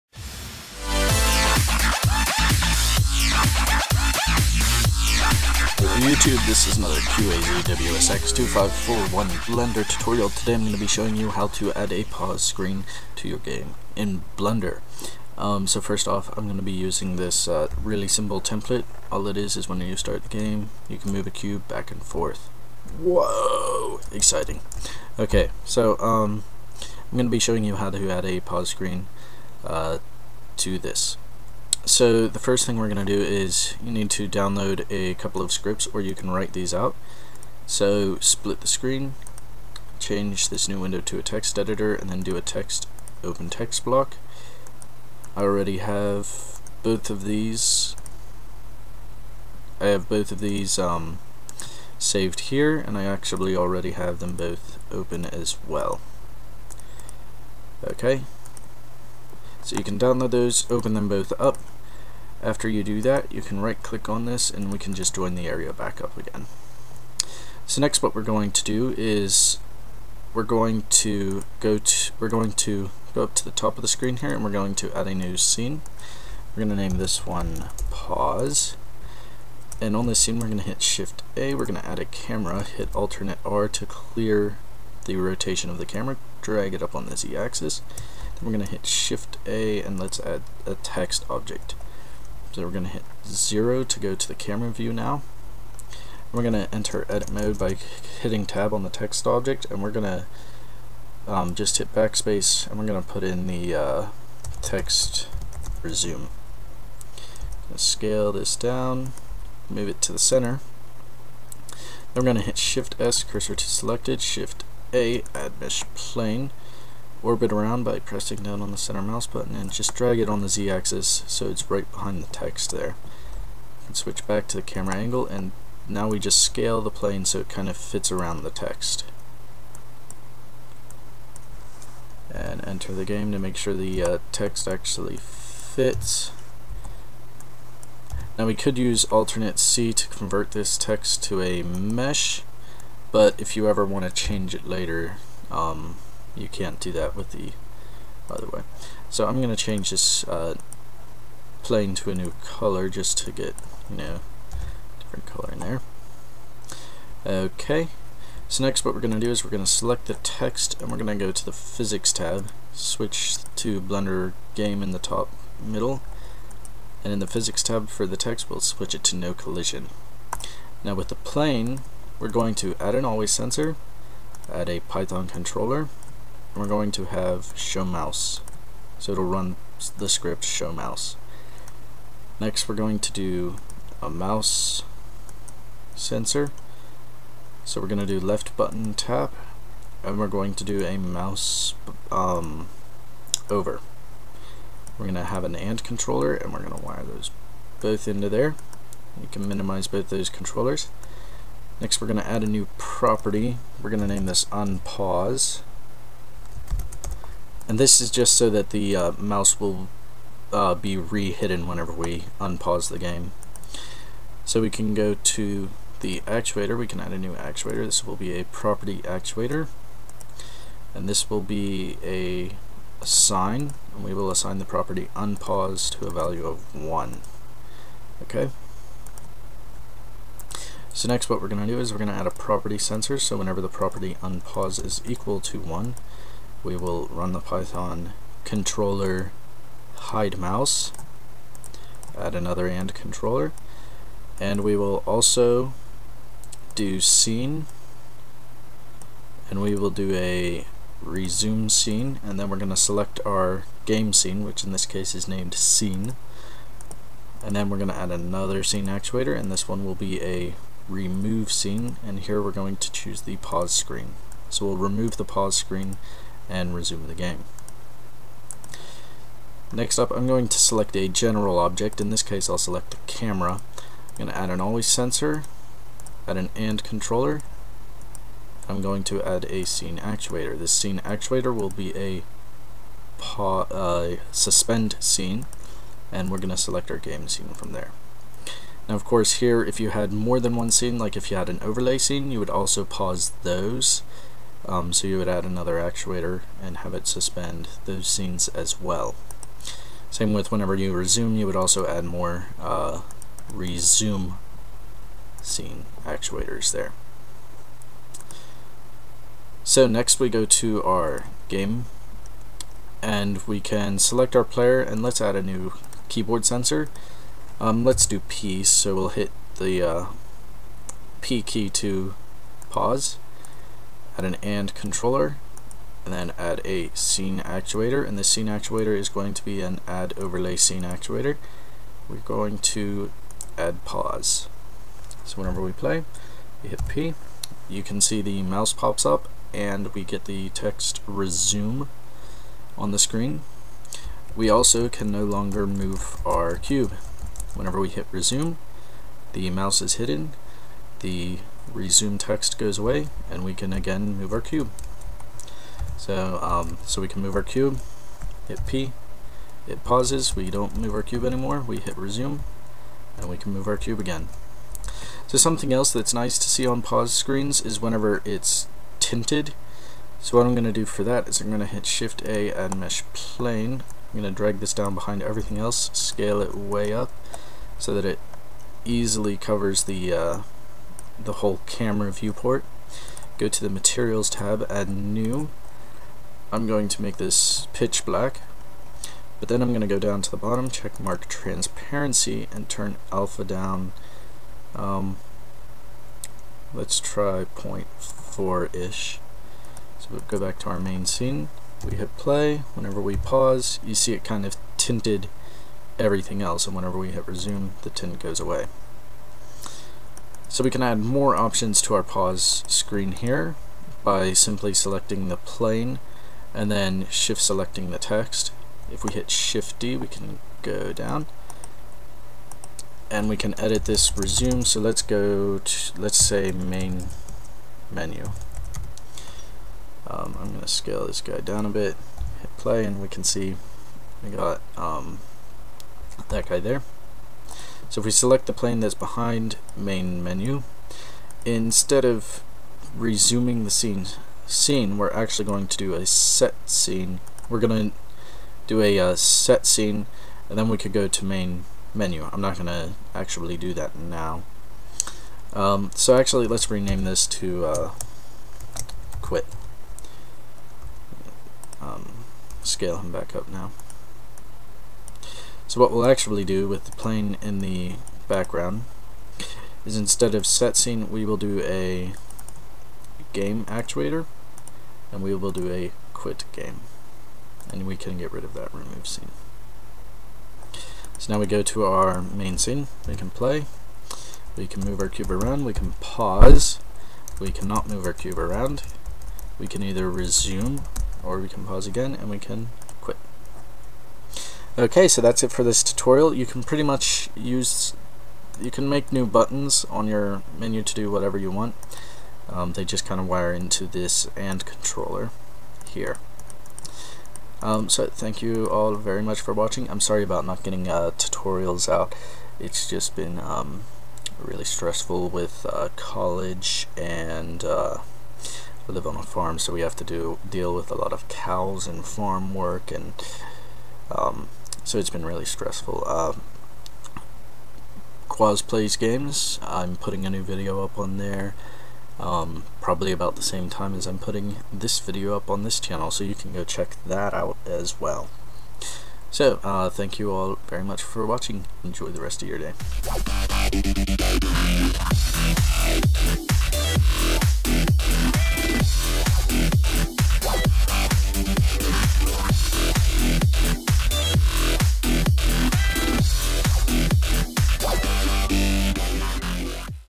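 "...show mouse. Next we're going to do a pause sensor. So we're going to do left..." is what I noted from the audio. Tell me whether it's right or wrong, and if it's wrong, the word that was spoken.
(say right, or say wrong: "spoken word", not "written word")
wrong: "mouse", not "pause".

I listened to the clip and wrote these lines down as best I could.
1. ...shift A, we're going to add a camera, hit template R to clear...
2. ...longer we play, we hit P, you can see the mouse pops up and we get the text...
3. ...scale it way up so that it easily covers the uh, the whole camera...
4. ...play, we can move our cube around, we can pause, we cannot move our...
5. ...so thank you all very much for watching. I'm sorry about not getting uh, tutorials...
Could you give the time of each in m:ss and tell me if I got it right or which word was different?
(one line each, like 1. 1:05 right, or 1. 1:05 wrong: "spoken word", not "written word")
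1. 1:20 wrong: "alternate", not "template"
2. 5:35 wrong: "whenever", not "longer"
3. 6:15 right
4. 8:03 right
5. 8:27 right.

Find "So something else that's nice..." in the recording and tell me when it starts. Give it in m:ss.
6:05.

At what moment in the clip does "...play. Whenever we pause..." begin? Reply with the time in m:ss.
6:42.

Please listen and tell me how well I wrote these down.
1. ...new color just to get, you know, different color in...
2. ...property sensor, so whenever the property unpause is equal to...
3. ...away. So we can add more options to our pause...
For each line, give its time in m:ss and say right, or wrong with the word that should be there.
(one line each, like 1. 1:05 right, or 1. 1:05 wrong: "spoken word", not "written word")
1. 2:32 right
2. 3:52 right
3. 6:48 right.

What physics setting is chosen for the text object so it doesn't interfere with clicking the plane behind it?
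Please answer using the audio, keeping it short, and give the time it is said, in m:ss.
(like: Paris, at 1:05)
no collision, at 2:49.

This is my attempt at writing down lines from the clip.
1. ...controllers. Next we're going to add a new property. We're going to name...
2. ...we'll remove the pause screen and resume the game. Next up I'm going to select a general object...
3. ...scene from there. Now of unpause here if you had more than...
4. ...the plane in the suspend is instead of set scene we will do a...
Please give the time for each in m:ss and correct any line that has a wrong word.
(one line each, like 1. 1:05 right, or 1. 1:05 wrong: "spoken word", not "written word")
1. 3:20 right
2. 4:24 right
3. 4:47 wrong: "course", not "unpause"
4. 7:46 wrong: "background", not "suspend".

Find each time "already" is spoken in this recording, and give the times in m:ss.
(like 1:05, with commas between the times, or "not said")
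0:45, 0:53.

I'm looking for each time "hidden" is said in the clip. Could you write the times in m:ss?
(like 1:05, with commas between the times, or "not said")
3:30, 5:49.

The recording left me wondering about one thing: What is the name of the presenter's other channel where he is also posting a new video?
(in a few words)
Quaz Plays Games.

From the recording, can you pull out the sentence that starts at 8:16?
You can pretty much use, you can make new buttons on your menu to do whatever you want.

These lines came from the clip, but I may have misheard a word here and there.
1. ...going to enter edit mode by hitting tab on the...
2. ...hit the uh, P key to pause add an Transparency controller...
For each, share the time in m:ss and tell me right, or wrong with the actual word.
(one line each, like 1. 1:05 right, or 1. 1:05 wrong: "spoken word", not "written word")
1. 1:36 right
2. 5:19 wrong: "AND", not "Transparency".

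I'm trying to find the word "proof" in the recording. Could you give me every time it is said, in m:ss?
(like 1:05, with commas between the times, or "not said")
not said.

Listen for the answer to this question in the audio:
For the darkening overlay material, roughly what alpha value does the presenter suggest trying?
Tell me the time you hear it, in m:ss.
6:37.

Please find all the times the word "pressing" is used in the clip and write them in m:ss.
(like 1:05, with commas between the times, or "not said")
1:57.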